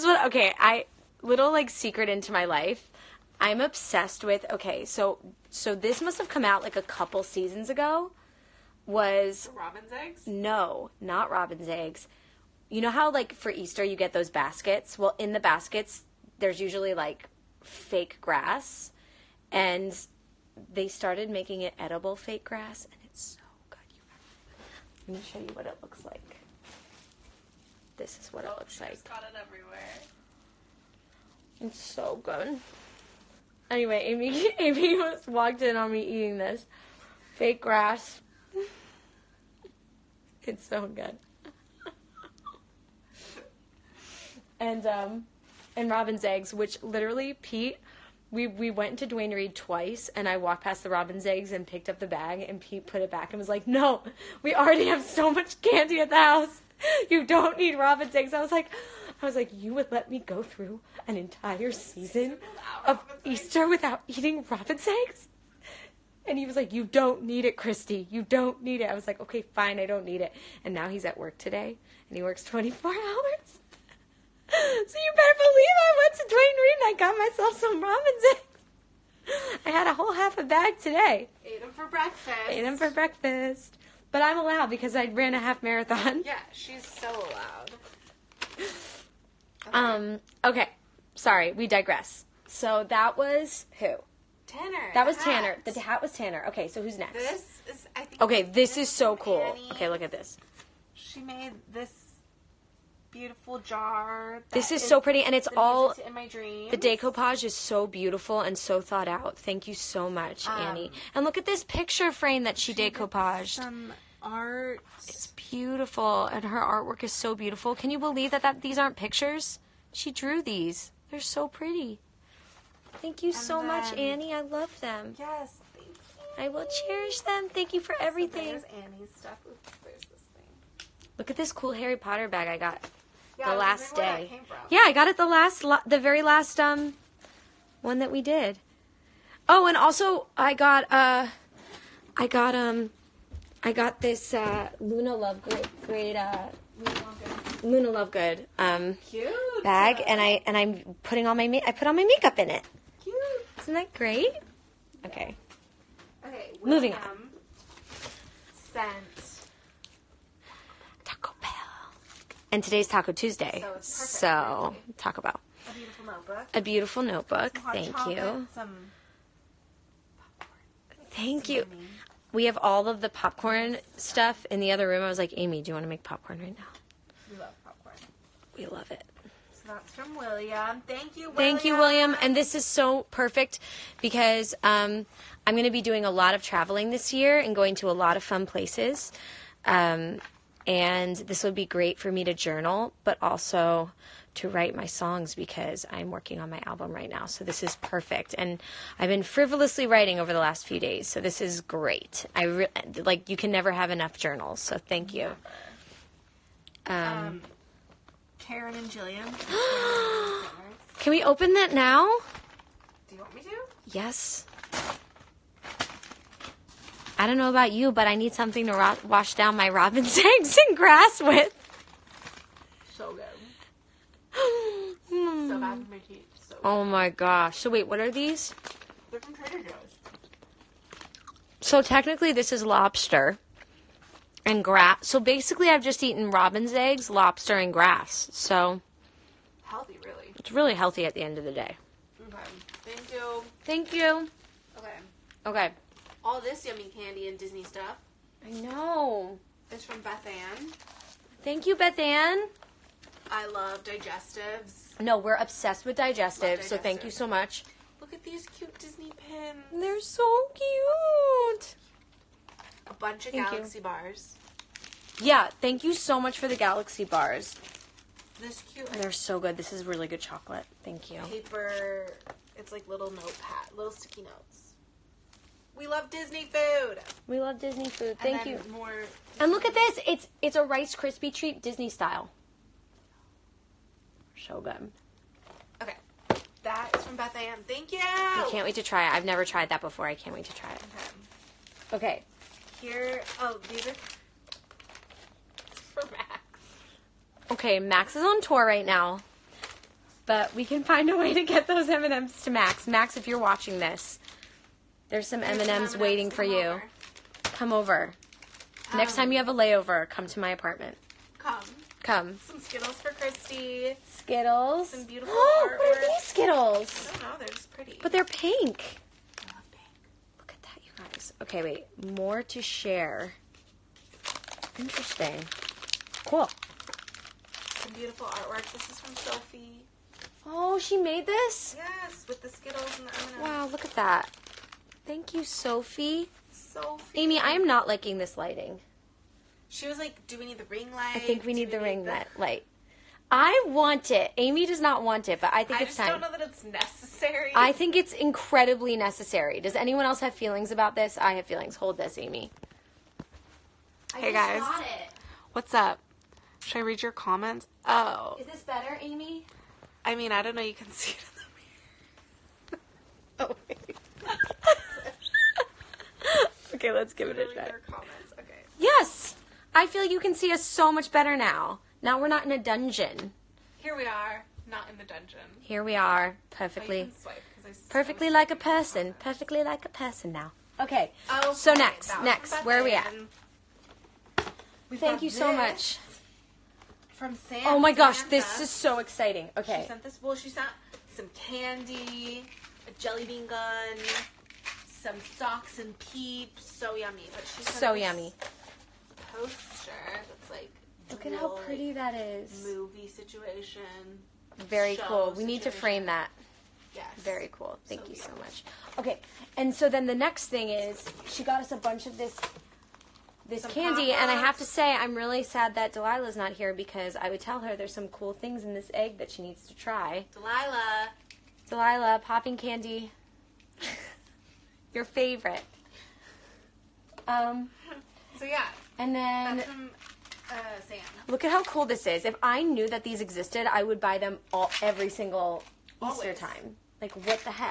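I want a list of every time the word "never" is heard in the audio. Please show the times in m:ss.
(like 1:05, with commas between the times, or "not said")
3:23, 4:49.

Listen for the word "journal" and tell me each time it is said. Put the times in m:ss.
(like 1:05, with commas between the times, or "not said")
3:12, 3:24.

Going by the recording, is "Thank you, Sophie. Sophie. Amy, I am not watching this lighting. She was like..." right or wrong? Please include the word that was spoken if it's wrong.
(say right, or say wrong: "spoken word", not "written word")
wrong: "liking", not "watching".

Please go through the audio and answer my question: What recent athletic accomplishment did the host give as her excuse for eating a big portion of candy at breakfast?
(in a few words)
half marathon.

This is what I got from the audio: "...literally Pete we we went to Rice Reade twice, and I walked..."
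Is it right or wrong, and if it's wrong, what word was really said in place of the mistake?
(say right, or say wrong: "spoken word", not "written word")
wrong: "Duane", not "Rice".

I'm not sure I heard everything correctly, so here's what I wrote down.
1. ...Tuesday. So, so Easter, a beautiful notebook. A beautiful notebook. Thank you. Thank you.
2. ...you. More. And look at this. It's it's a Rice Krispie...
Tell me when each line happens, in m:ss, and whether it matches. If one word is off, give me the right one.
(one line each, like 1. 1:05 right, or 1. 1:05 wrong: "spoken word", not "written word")
1. 2:43 wrong: "Bell", not "Easter"
2. 4:38 right.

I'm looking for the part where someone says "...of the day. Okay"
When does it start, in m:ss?
4:01.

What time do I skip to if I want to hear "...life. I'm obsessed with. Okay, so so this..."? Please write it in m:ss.
0:02.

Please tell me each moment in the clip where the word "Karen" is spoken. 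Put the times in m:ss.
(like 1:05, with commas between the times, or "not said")
3:28.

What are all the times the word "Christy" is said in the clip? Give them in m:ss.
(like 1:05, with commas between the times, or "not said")
1:07, 5:13.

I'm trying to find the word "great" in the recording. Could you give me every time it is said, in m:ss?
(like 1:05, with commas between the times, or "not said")
2:25, 2:33, 3:11, 3:21.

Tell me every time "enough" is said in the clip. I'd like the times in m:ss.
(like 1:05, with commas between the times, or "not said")
3:23.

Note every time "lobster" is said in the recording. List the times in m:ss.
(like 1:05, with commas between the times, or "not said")
3:52, 3:57.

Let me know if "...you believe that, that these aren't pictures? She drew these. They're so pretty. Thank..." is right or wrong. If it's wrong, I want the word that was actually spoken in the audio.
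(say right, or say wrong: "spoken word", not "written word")
right.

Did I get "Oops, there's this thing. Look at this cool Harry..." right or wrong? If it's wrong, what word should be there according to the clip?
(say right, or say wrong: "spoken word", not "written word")
right.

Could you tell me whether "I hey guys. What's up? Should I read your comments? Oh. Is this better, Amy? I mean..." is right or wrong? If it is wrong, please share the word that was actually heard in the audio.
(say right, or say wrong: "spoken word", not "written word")
right.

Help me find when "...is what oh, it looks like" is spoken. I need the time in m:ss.
0:28.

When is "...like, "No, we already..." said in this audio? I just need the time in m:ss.
0:53.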